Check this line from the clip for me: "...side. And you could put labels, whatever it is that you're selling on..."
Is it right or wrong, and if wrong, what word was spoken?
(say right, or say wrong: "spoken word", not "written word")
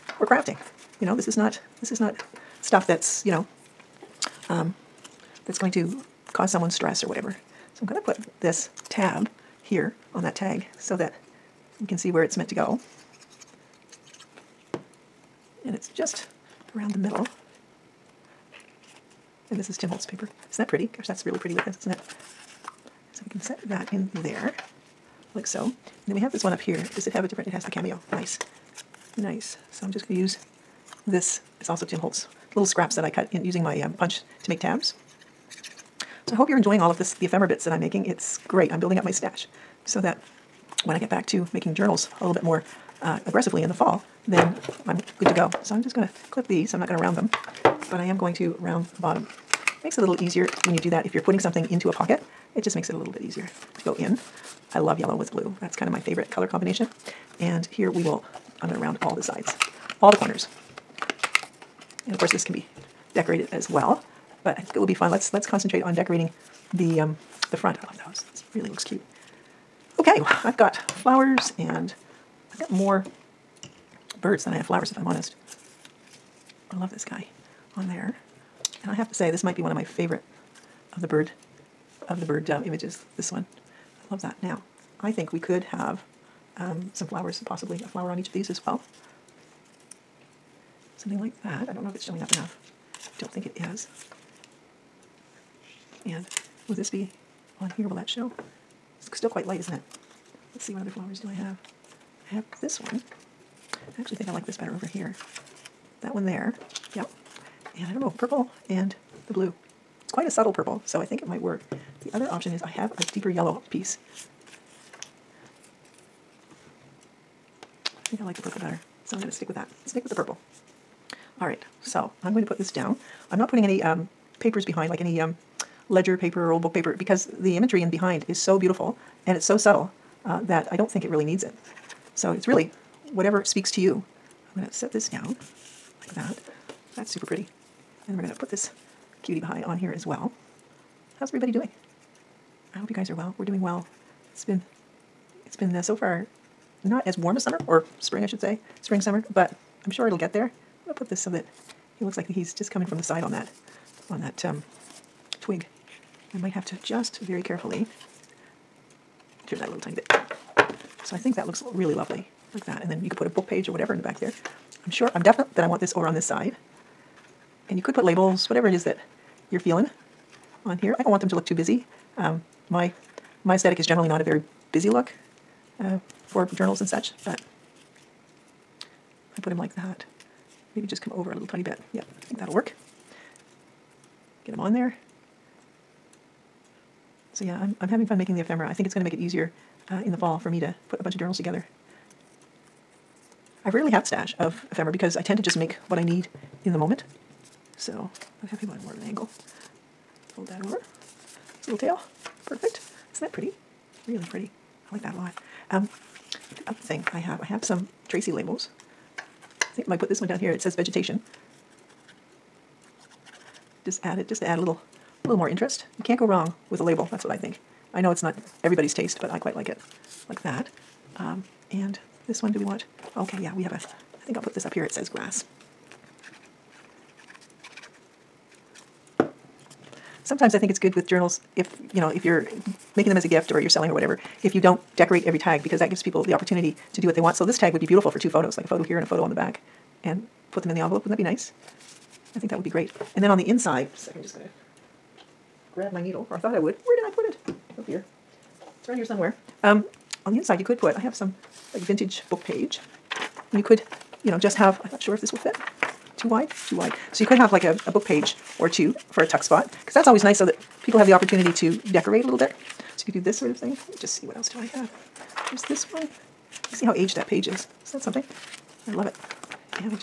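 wrong: "feeling", not "selling".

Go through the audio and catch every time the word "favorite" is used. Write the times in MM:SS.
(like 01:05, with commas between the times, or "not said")
00:55, 01:19.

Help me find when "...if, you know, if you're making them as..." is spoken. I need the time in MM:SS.
03:51.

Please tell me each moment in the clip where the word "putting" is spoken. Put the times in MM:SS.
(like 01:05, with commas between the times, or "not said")
00:51, 02:03.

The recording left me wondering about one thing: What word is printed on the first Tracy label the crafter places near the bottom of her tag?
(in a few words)
vegetation.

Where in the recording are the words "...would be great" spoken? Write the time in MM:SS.
04:02.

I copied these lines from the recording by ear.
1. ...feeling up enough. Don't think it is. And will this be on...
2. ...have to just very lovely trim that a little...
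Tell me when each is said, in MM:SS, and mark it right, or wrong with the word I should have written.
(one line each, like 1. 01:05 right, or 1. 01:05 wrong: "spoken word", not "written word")
1. 01:32 wrong: "showing", not "feeling"
2. 02:36 wrong: "carefully", not "lovely".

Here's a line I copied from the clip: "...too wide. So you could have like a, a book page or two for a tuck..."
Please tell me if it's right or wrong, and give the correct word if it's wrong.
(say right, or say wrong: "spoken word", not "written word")
right.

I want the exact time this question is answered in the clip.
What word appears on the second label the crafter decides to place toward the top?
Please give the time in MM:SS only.
03:45.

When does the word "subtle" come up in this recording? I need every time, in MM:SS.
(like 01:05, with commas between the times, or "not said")
01:50, 02:09.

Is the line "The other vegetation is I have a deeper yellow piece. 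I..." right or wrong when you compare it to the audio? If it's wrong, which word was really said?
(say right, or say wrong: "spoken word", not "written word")
wrong: "option", not "vegetation".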